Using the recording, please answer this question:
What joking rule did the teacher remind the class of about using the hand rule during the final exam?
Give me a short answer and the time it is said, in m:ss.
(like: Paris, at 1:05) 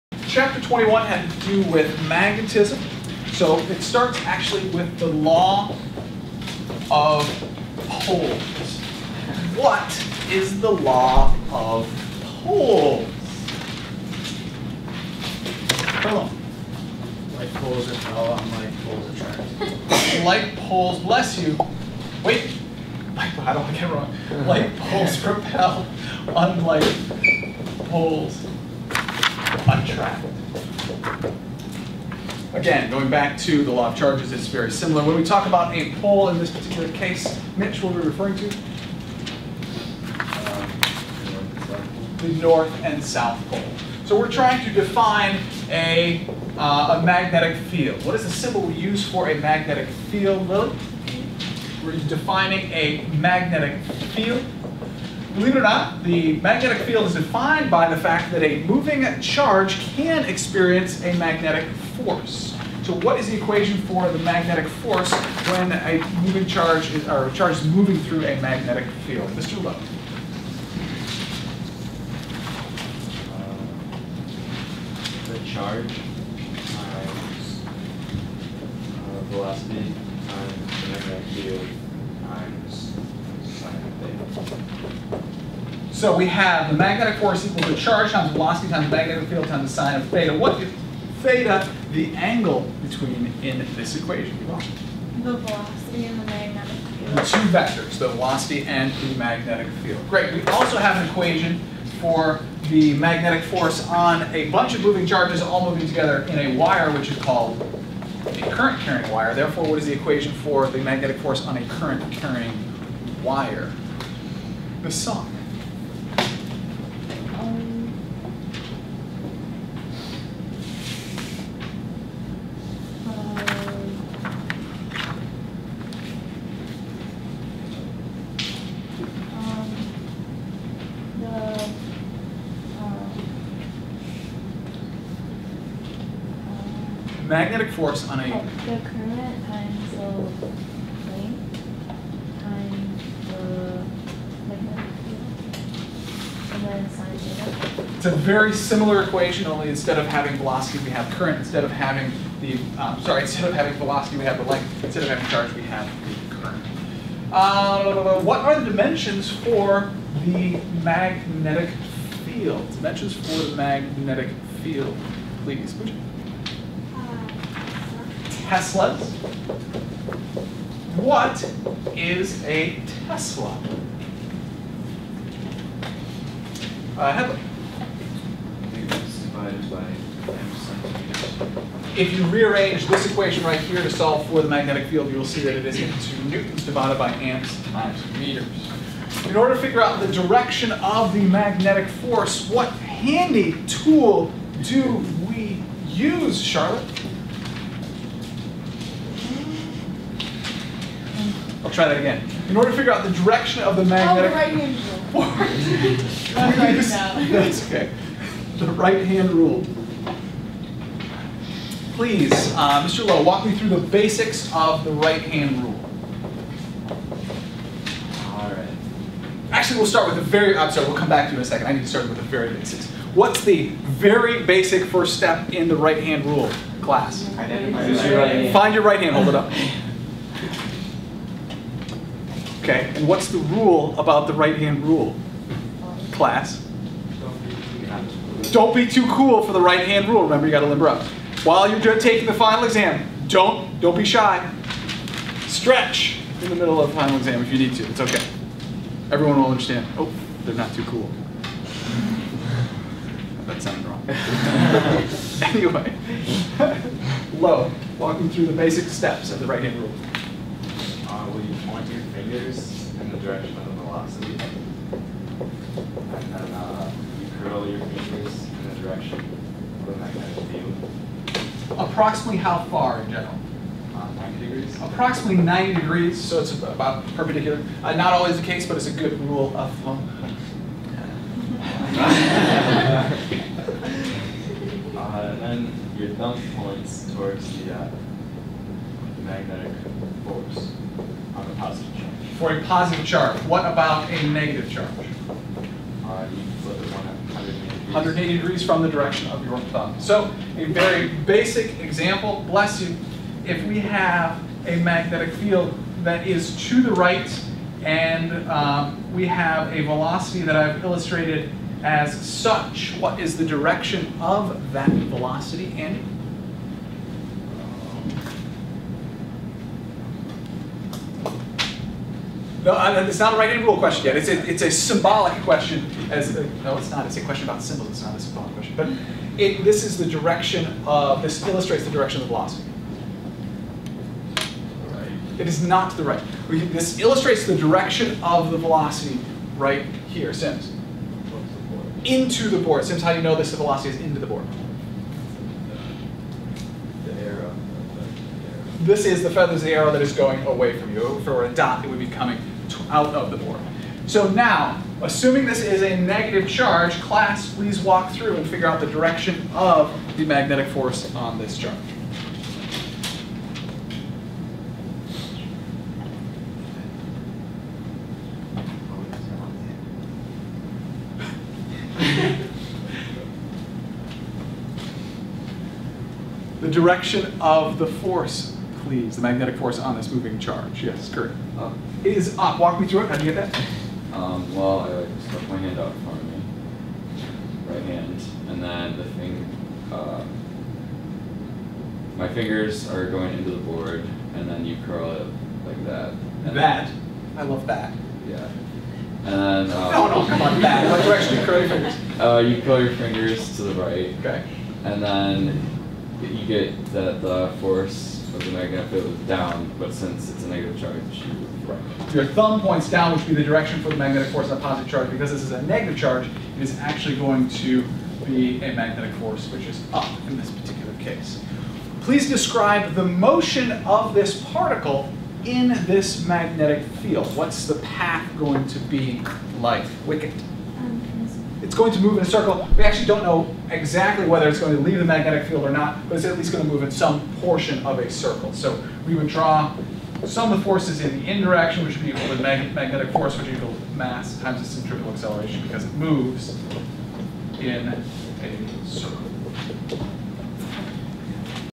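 Don't be too cool, at 3:58.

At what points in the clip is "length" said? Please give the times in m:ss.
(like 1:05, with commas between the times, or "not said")
2:21, 2:34.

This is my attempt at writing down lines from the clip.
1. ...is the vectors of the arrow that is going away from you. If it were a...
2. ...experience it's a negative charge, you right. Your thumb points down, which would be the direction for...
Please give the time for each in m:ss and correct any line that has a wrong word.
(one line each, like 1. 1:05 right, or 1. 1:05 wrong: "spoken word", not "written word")
1. 5:49 wrong: "feathers", not "vectors"
2. 6:49 wrong: "since", not "experience".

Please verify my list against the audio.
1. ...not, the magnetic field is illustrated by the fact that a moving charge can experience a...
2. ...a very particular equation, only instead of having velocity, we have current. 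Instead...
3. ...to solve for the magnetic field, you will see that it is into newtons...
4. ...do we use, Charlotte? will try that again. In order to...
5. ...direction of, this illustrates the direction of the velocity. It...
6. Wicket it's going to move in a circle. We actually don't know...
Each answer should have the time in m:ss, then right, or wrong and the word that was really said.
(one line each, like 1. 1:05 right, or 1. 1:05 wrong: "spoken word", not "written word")
1. 0:55 wrong: "defined", not "illustrated"
2. 2:28 wrong: "similar", not "particular"
3. 3:03 right
4. 3:14 right
5. 5:30 right
6. 7:10 right.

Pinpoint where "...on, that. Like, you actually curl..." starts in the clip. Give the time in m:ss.
6:40.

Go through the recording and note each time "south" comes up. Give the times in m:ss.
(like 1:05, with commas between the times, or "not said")
0:43.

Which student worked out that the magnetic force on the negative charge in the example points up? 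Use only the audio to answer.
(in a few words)
Kurt.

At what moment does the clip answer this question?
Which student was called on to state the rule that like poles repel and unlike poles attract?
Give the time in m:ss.
0:15.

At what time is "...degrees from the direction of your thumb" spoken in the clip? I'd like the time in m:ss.
4:58.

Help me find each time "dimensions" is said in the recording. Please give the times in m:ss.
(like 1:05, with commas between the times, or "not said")
2:38, 2:42.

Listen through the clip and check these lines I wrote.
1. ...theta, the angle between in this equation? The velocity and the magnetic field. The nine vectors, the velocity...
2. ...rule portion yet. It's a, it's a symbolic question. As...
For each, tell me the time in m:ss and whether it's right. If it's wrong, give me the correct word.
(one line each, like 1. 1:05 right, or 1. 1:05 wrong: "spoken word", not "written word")
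1. 1:31 wrong: "two", not "nine"
2. 5:23 wrong: "question", not "portion".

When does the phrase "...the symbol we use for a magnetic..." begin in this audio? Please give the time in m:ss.
0:48.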